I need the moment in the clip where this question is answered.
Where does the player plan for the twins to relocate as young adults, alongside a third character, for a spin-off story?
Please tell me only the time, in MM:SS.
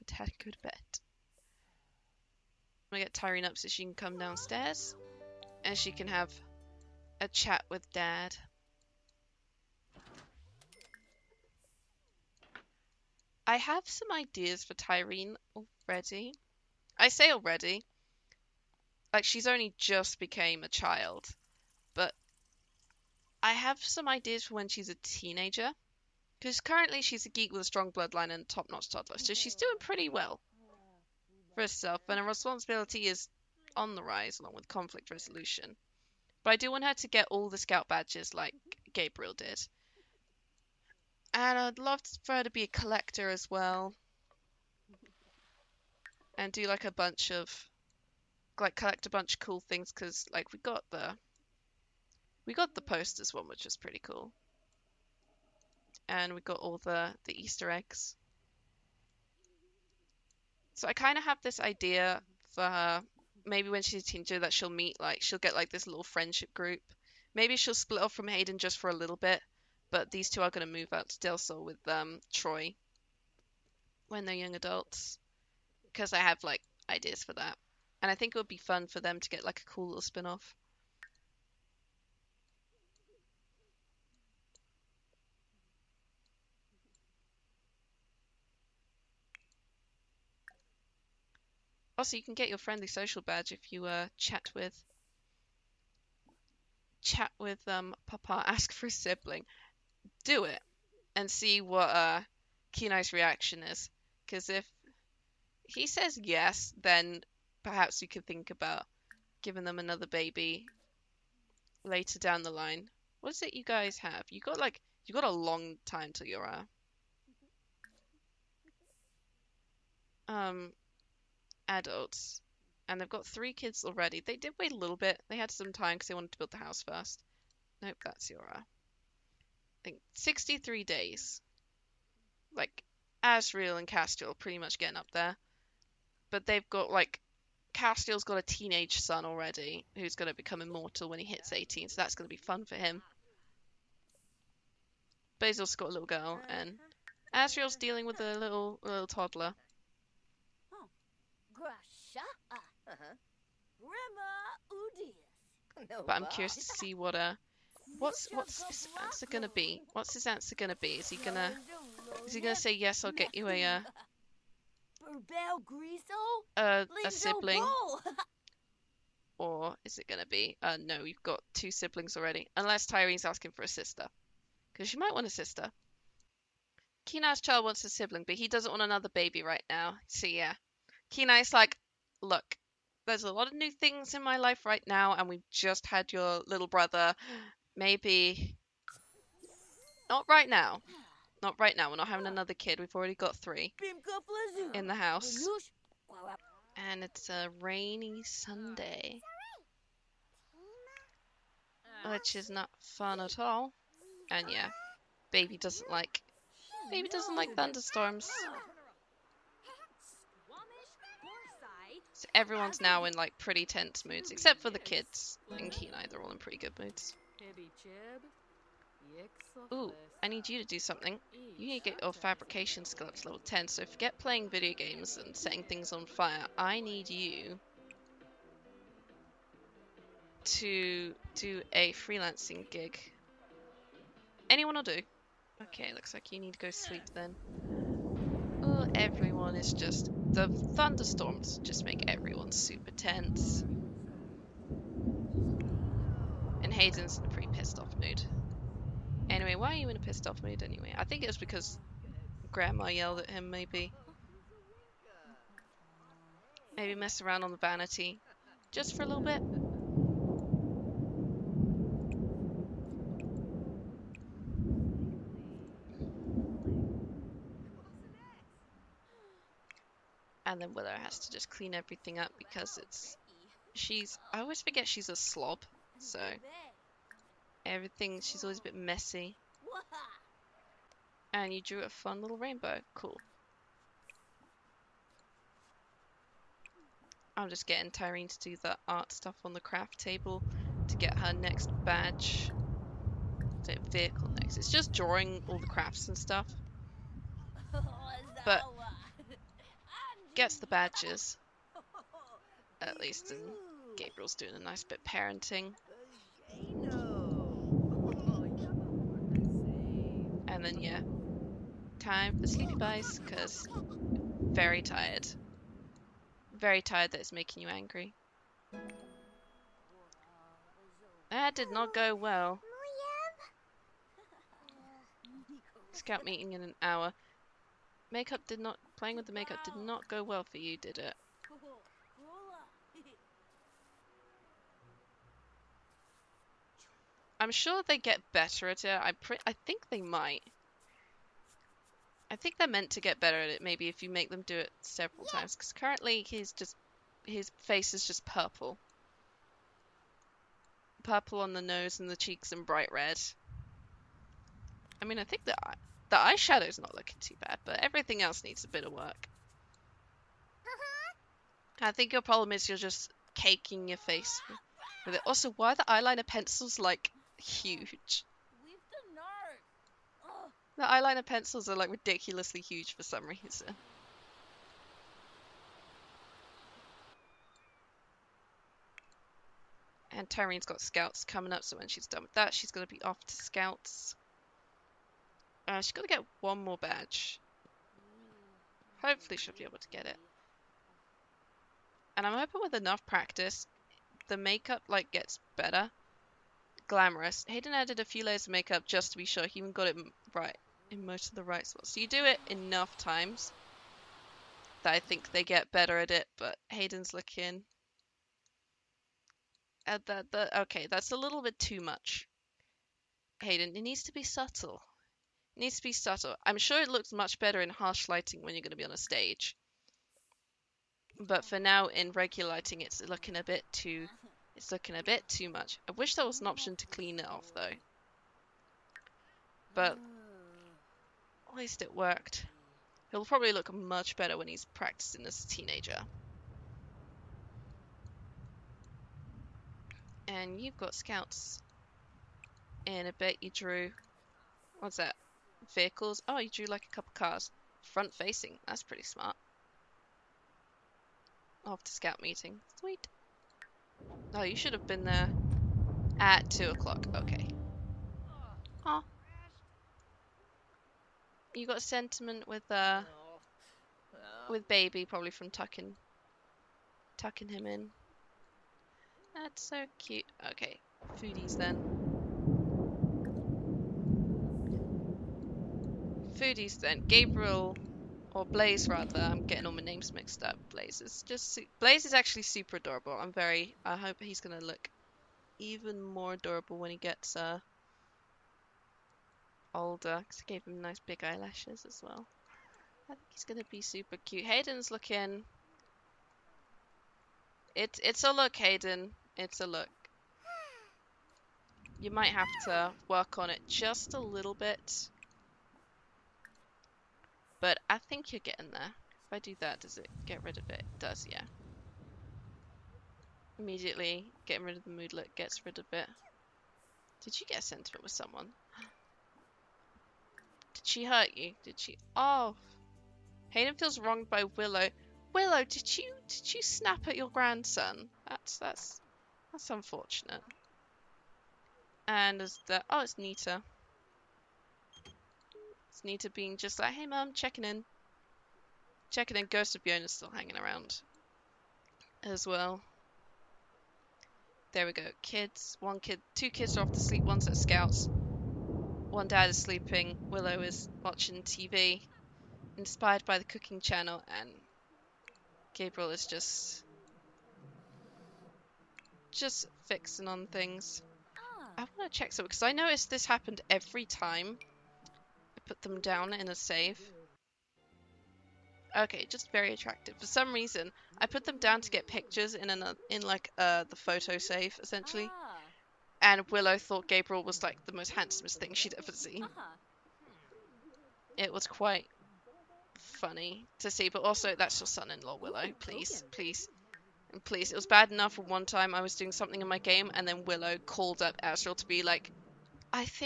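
01:11.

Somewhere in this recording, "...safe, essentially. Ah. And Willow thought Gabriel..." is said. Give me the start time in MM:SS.
09:34.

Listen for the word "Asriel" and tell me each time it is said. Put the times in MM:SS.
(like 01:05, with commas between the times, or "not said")
02:13, 02:27, 09:51.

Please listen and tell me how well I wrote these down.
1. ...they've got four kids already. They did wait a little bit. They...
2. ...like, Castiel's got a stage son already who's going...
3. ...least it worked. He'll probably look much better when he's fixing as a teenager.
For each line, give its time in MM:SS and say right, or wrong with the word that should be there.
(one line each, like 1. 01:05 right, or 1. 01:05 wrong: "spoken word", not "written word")
1. 02:02 wrong: "three", not "four"
2. 02:16 wrong: "teenage", not "stage"
3. 07:11 wrong: "practicing", not "fixing".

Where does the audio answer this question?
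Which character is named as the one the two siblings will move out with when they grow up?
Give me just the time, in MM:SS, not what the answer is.
01:12.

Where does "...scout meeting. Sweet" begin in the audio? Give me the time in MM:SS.
07:31.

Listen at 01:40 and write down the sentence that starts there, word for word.
Do it and see what uh, Kenai's reaction is.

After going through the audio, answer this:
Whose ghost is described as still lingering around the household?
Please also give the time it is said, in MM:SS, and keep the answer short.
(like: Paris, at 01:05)
Yona, at 08:59.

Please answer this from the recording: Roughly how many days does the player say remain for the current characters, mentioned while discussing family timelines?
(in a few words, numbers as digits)
63.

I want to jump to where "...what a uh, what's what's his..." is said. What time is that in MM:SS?
02:36.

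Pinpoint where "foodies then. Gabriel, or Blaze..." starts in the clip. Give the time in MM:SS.
07:56.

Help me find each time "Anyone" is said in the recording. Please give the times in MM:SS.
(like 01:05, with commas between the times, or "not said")
03:54.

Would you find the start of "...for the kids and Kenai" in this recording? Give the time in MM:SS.
03:34.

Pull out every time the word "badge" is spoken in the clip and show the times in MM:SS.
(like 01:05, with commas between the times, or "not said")
00:37, 01:33, 04:51, 05:00, 06:26.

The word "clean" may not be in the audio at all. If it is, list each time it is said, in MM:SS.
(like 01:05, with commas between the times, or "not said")
04:31, 07:06.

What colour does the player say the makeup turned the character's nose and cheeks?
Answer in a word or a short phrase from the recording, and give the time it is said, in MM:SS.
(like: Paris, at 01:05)
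purple, at 05:48.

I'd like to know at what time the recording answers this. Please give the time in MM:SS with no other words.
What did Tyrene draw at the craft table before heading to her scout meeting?
07:25.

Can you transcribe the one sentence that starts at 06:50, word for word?
The, okay, that's a little bit too much.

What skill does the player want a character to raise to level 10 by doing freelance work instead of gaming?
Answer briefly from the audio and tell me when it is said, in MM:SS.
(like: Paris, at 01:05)
fabrication, at 03:42.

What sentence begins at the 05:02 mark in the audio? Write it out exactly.
At least, and Gabriel's doing a nice bit parenting.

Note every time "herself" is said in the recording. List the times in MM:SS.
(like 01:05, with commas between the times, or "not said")
00:31.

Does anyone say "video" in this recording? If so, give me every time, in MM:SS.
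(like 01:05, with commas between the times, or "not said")
03:44.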